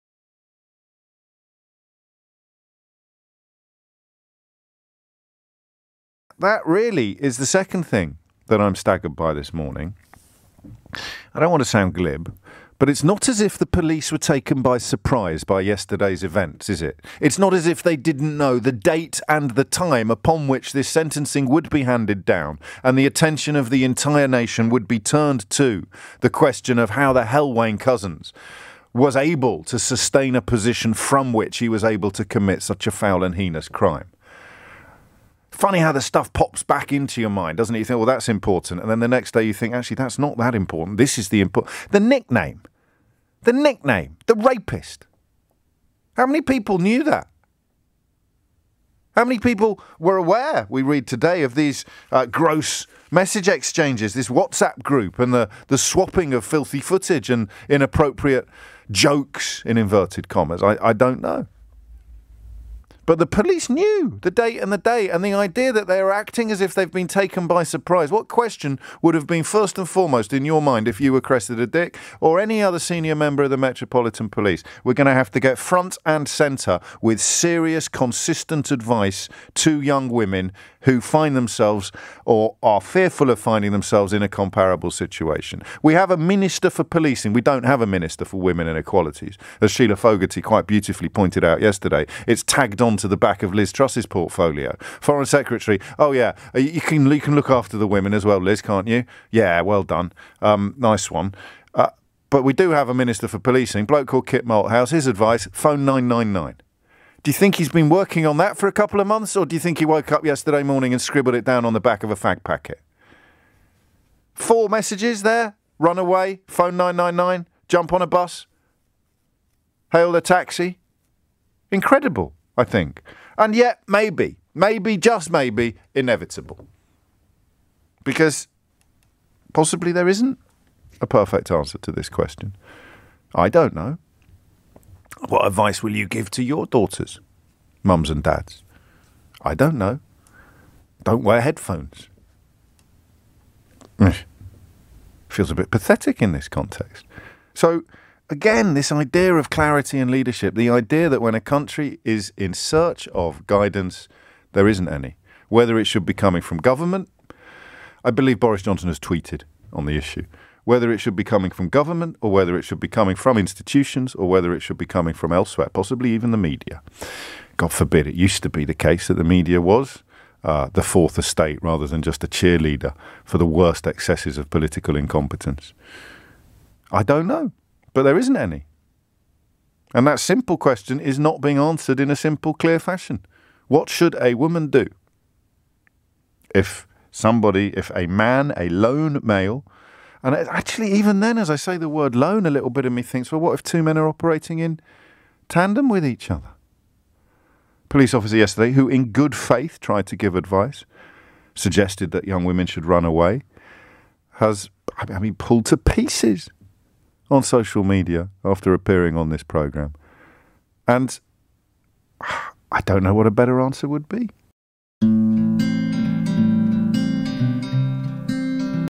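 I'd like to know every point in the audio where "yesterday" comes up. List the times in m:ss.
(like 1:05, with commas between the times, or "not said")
0:15, 1:31, 1:50, 3:18.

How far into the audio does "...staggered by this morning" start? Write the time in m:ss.
0:08.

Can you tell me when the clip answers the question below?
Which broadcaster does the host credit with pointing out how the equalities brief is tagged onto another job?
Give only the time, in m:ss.
1:29.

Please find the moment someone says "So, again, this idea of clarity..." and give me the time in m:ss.
2:27.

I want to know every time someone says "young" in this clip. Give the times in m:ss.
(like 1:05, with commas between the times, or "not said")
1:19, 3:22.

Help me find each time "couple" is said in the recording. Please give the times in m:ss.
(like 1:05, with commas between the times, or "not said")
1:48.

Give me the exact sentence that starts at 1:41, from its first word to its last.
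Uh, but we do have a minister for policing, bloke called Kit Malthouse.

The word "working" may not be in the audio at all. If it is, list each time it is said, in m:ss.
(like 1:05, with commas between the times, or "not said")
1:47.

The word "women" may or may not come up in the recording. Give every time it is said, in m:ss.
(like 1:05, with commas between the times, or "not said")
1:20, 1:28, 1:37, 3:22.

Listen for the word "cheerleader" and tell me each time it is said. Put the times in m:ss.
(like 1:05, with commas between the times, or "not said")
2:52.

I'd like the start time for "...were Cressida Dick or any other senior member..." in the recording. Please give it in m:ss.
1:11.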